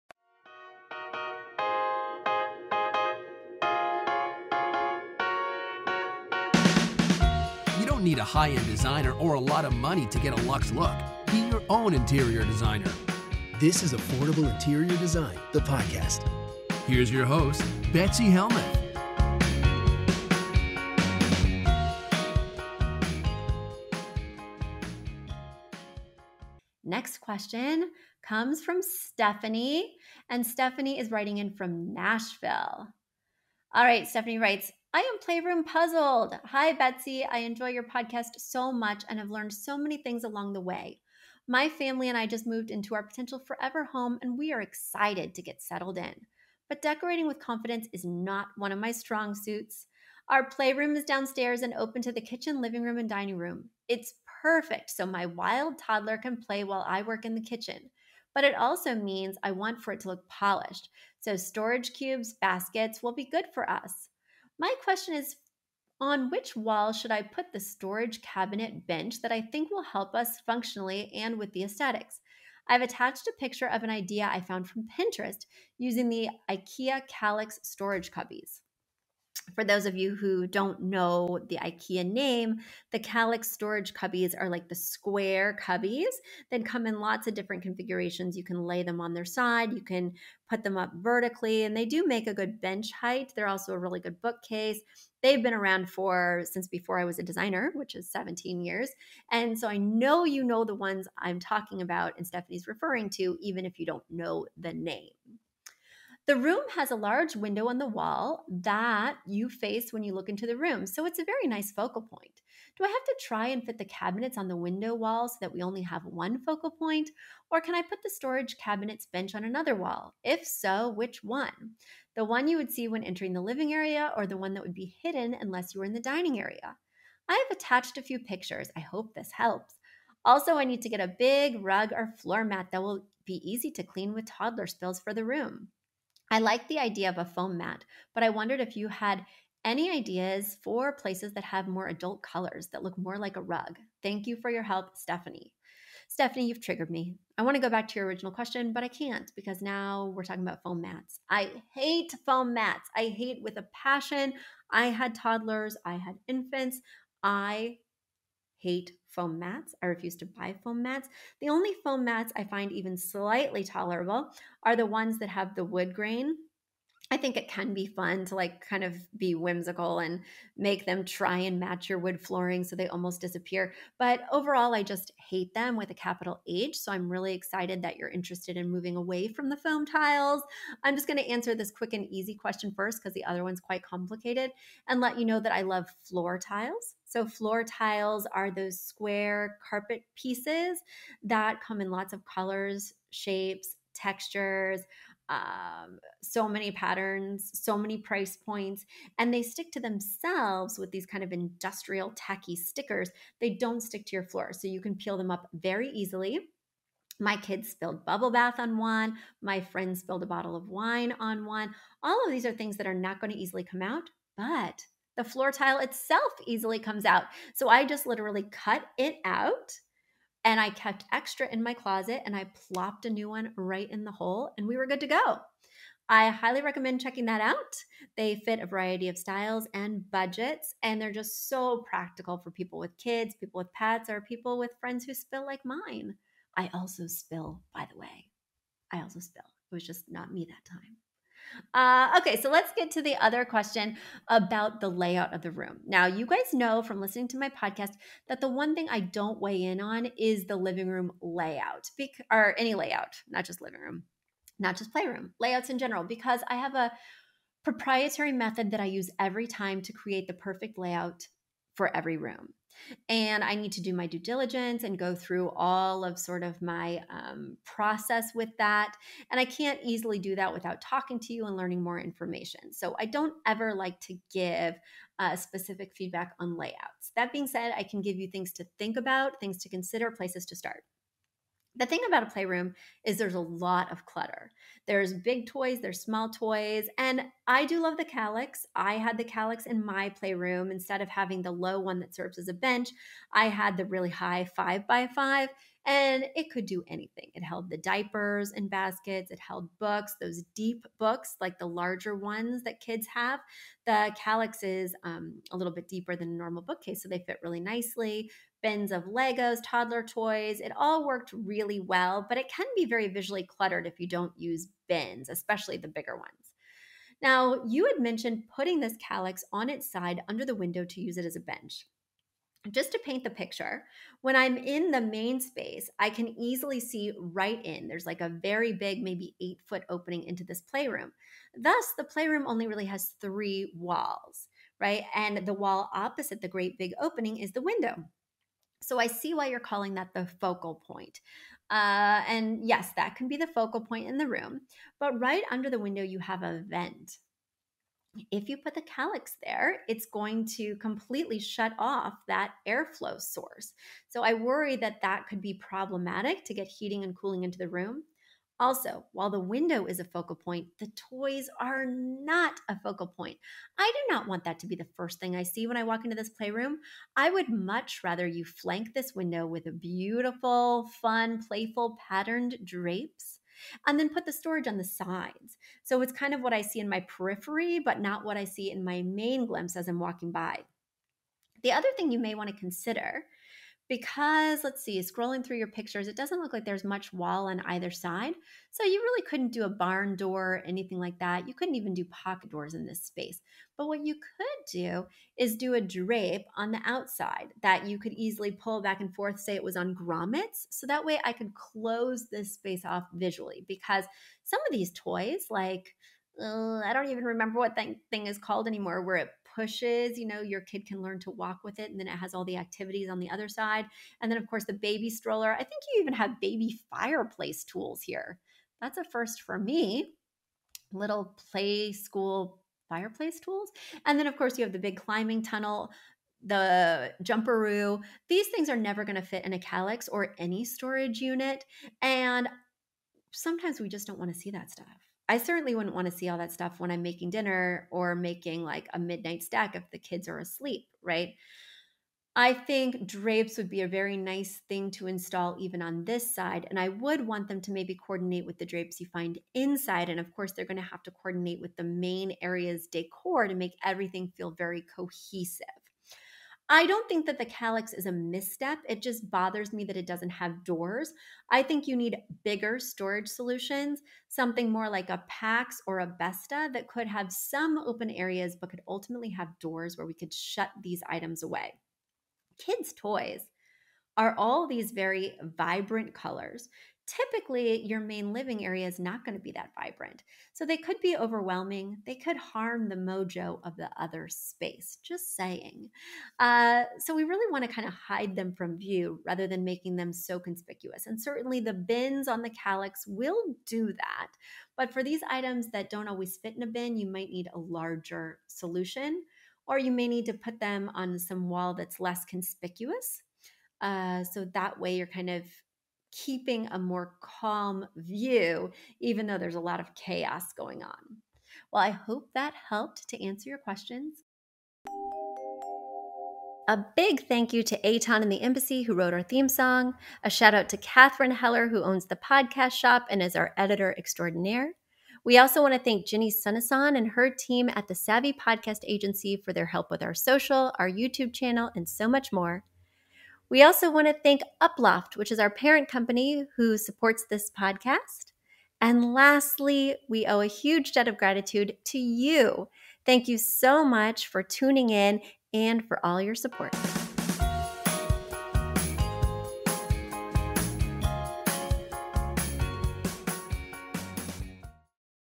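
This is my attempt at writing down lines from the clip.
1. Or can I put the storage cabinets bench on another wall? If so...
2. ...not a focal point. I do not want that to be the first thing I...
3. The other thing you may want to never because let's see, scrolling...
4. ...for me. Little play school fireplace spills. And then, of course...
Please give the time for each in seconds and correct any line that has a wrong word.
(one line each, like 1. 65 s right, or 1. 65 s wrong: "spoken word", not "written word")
1. 117 s right
2. 361 s right
3. 381 s wrong: "consider", not "never"
4. 419 s wrong: "tools", not "spills".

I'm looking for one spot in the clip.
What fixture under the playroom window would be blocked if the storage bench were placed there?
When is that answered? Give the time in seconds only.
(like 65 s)
346 s.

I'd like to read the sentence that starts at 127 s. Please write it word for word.
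I have attached a few pictures.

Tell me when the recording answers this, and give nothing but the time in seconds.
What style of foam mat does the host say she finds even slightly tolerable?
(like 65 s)
165 s.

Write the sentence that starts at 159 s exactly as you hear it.
I refuse to buy foam mats.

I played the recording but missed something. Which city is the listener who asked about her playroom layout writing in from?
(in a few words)
Nashville.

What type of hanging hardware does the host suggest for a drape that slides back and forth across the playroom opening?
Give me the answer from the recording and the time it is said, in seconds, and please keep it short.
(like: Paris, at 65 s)
Grommets, at 399 s.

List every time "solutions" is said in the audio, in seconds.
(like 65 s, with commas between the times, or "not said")
463 s, 498 s.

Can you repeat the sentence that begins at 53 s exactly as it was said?
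It's perfect so my wild toddler can play while I work in the kitchen.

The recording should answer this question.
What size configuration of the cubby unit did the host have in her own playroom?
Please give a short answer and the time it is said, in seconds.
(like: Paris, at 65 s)
5 by 5, at 294 s.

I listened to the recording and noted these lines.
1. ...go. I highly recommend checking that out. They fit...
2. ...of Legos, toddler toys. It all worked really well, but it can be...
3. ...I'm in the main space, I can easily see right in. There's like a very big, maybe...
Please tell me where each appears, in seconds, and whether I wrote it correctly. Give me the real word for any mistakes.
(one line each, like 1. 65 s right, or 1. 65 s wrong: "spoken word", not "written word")
1. 225 s right
2. 308 s right
3. 324 s right.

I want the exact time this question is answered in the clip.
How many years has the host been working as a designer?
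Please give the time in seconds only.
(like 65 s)
98 s.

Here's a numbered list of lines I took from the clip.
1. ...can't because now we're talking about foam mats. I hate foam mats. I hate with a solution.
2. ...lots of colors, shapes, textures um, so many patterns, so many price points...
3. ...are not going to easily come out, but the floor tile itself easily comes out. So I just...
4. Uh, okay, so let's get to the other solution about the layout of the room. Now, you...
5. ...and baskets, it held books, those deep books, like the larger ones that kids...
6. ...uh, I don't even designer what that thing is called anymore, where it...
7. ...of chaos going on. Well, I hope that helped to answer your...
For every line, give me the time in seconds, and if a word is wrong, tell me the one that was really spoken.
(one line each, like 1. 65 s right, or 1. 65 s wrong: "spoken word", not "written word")
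1. 148 s wrong: "passion", not "solution"
2. 191 s right
3. 212 s right
4. 241 s wrong: "question", not "solution"
5. 298 s right
6. 406 s wrong: "remember", not "designer"
7. 509 s right.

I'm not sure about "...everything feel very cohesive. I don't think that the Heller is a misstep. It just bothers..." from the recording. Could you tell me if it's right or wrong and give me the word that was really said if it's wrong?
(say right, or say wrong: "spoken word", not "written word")
wrong: "Kallax", not "Heller".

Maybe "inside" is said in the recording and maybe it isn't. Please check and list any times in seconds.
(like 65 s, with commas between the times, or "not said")
449 s.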